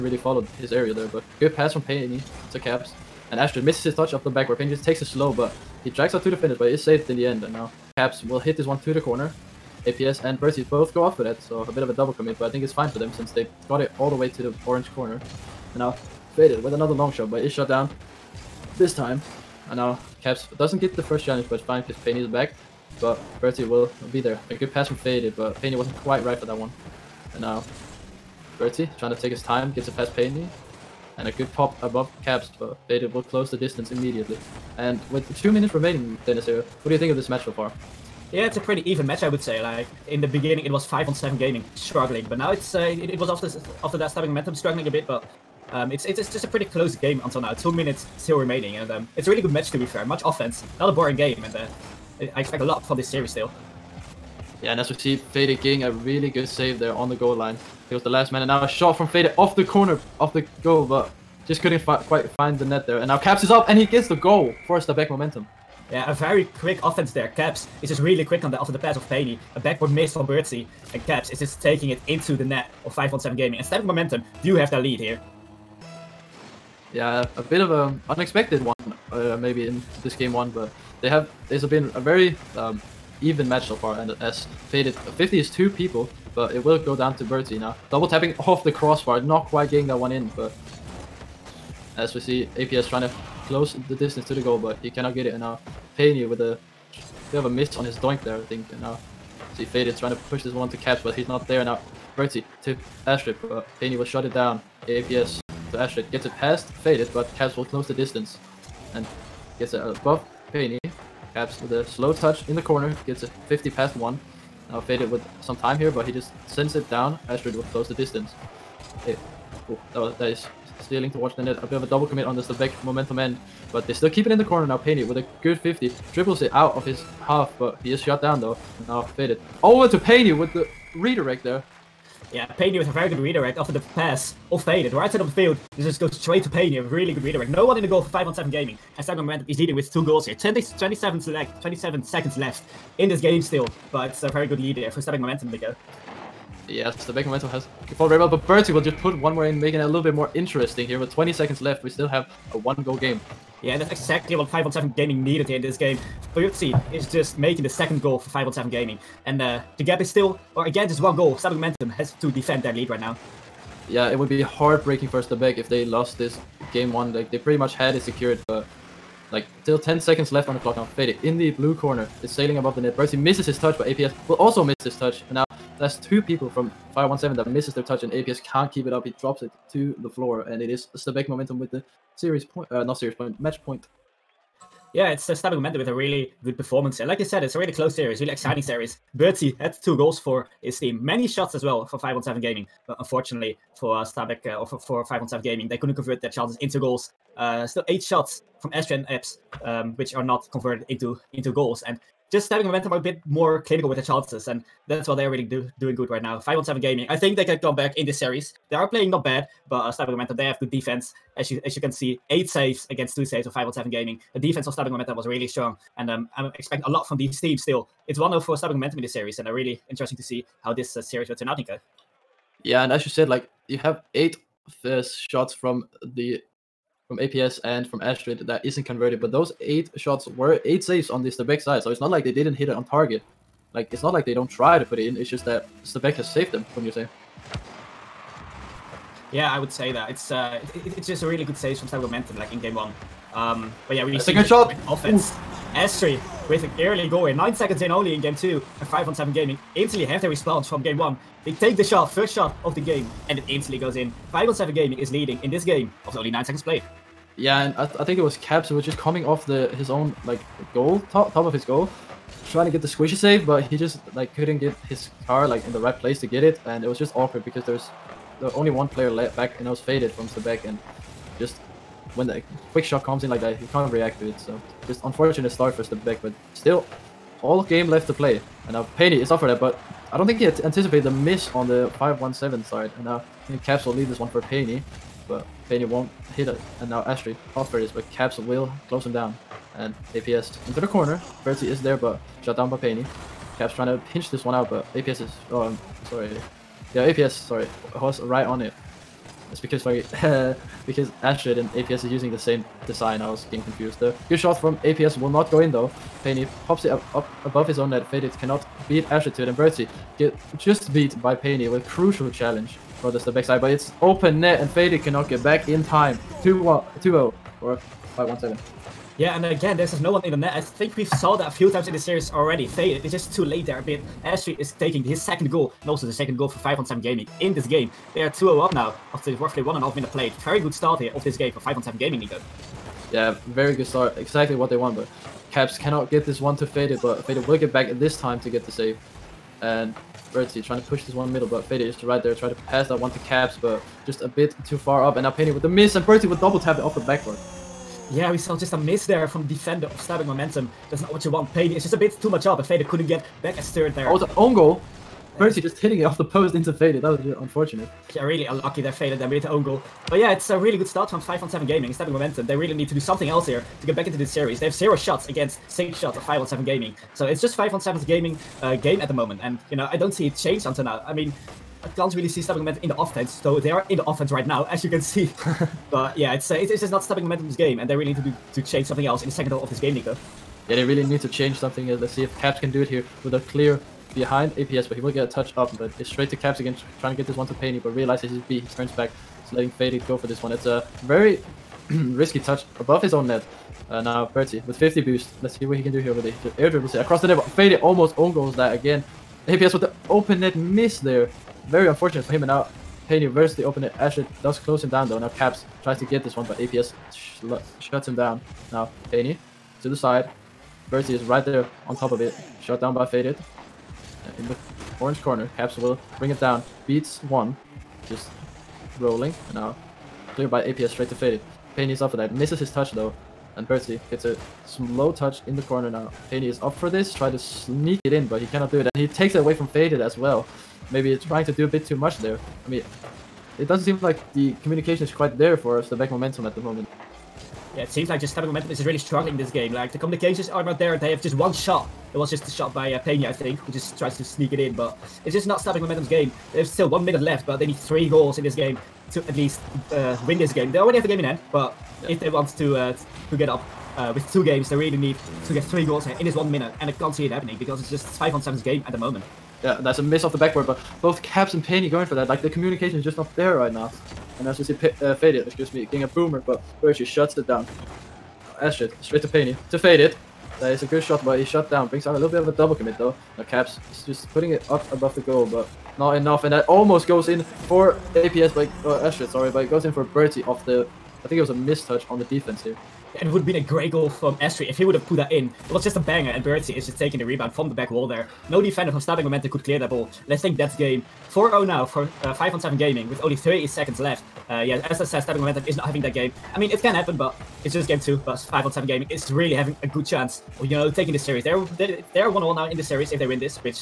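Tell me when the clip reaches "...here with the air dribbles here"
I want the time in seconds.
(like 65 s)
395 s.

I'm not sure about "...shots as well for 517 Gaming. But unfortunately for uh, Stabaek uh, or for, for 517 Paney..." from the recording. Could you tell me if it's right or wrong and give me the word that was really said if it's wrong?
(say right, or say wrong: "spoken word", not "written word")
wrong: "Gaming", not "Paney".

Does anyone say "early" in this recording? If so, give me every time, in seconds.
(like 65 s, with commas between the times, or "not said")
246 s.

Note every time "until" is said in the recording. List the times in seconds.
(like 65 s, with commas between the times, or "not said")
47 s, 370 s.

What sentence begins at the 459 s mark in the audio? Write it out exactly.
Yeah, that's a miss off the backboard, but both Caps and Penny going for that.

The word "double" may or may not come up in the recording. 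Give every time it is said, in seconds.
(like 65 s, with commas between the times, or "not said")
11 s, 87 s, 121 s, 346 s, 472 s.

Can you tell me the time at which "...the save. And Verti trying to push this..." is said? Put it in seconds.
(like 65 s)
338 s.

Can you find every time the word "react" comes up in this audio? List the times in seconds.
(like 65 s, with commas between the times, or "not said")
273 s.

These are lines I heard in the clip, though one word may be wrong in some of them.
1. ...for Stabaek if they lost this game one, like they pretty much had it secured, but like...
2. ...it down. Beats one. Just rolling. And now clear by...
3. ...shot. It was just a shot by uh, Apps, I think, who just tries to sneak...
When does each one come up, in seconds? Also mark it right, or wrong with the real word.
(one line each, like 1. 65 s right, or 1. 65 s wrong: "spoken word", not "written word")
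1. 165 s right
2. 416 s right
3. 441 s wrong: "Pena", not "Apps".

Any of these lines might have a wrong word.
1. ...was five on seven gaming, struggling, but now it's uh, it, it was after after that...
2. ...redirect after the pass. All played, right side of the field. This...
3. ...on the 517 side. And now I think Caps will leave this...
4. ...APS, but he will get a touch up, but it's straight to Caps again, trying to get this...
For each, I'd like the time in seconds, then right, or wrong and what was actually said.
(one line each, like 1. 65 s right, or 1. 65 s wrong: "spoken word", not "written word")
1. 40 s right
2. 133 s wrong: "faded", not "played"
3. 281 s right
4. 384 s right.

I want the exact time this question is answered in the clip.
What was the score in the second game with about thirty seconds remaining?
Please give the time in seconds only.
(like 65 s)
491 s.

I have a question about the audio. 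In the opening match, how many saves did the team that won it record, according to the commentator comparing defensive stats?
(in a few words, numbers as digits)
8.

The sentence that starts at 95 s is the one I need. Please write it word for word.
And now Payne with a bit of a miss on his doink there, I think.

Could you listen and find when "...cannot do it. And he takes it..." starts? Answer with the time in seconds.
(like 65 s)
428 s.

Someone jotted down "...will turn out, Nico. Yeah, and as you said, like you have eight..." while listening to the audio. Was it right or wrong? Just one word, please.
right.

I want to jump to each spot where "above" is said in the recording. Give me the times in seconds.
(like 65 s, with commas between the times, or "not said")
31 s, 109 s, 172 s, 307 s, 392 s, 474 s.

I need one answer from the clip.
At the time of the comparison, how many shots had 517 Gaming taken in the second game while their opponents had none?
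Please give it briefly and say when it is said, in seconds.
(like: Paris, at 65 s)
6, at 365 s.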